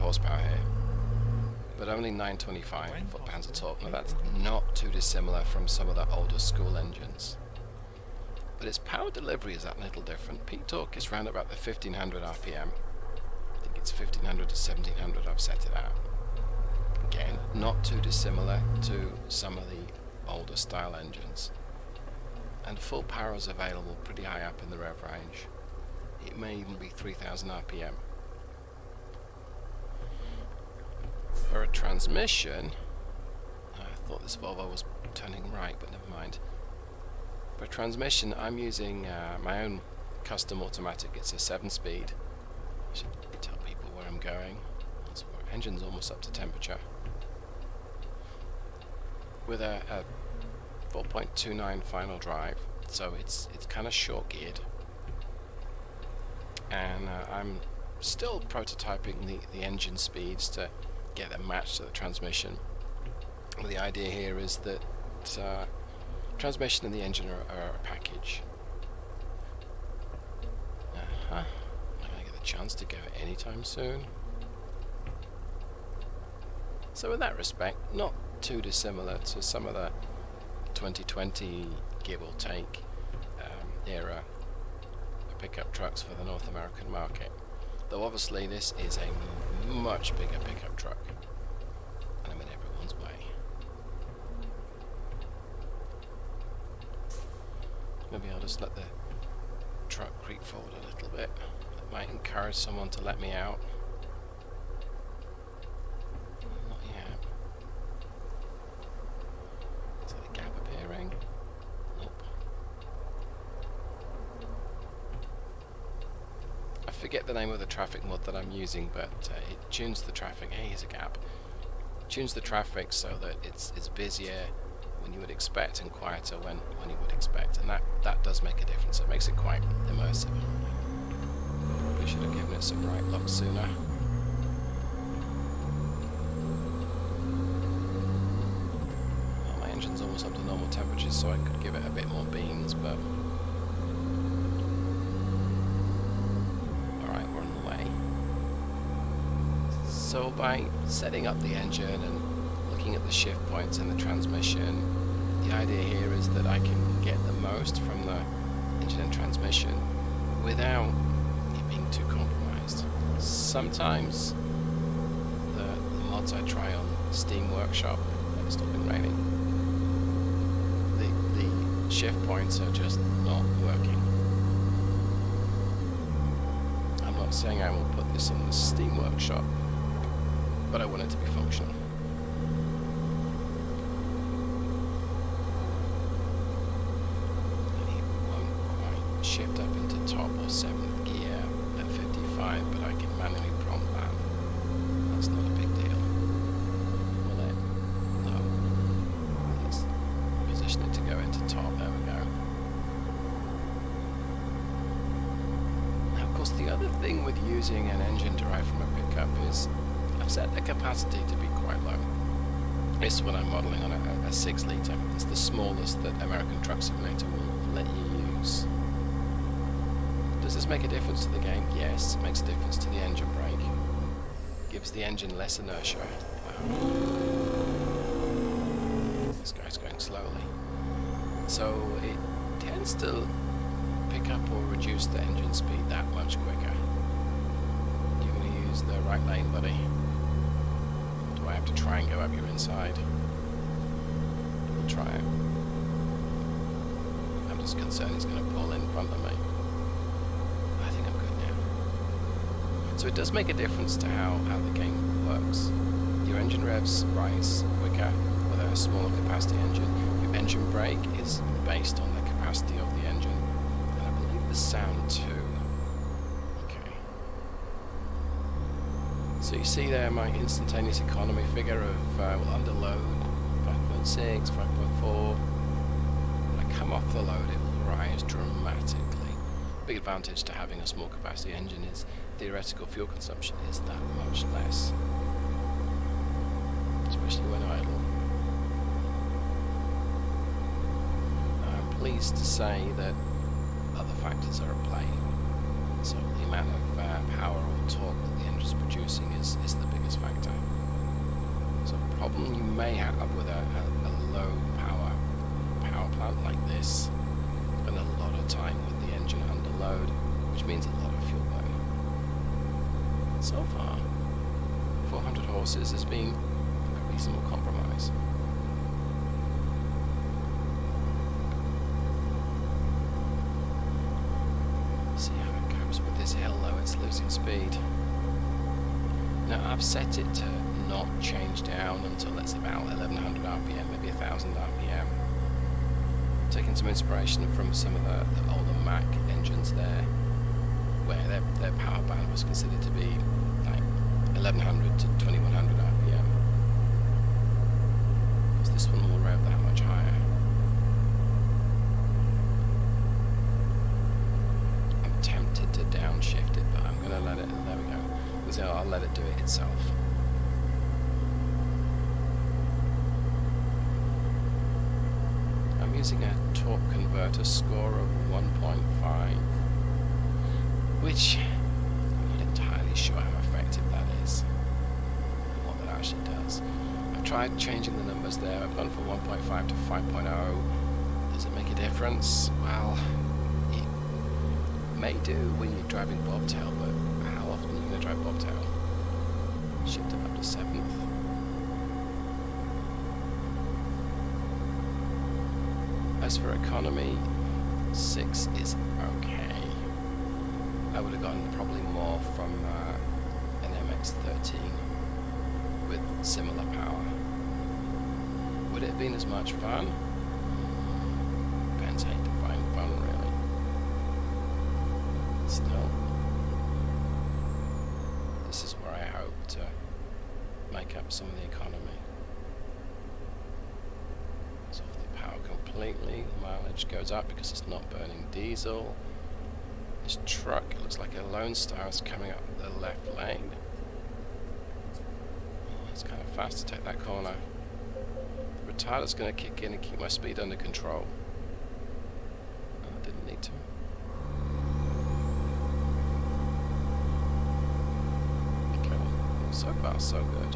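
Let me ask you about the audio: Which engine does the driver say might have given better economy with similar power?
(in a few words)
MX-13.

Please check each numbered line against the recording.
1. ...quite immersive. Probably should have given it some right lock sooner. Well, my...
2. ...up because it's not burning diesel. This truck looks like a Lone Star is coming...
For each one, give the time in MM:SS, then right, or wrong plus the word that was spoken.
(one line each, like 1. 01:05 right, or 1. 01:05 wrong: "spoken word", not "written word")
1. 02:09 right
2. 07:07 right.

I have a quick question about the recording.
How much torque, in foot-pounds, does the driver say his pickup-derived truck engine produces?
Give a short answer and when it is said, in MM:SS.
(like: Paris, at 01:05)
925, at 00:02.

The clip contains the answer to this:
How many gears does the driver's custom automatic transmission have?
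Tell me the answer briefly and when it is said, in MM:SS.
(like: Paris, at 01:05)
7, at 00:41.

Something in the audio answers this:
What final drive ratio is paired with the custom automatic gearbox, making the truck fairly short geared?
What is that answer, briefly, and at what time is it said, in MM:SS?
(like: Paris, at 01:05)
4.29, at 00:50.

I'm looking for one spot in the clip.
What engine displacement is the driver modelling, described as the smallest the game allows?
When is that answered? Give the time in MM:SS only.
03:34.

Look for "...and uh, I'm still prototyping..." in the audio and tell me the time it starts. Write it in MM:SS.
00:56.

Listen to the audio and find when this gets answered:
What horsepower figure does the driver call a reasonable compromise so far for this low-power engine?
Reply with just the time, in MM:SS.
05:15.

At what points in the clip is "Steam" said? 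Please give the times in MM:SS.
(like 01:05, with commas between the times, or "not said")
02:47, 02:58.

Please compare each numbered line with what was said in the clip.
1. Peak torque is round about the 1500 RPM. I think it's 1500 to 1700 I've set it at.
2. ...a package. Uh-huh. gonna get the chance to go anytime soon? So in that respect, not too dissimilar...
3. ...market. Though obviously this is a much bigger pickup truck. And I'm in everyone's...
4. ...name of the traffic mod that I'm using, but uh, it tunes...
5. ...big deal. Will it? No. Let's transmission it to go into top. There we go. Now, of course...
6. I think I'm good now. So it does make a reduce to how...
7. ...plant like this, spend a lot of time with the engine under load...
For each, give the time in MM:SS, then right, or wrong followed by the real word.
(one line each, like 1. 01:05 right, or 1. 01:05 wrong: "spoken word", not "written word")
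1. 00:10 right
2. 01:07 right
3. 01:26 right
4. 01:57 right
5. 03:15 wrong: "position", not "transmission"
6. 04:10 wrong: "difference", not "reduce"
7. 05:06 right.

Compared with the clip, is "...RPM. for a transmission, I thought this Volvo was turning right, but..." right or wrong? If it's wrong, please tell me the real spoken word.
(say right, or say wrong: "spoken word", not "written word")
right.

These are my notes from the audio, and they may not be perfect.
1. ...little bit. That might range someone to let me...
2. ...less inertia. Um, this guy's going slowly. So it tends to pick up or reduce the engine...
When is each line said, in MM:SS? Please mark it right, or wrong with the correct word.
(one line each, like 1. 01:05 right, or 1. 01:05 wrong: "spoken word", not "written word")
1. 01:40 wrong: "encourage", not "range"
2. 03:45 right.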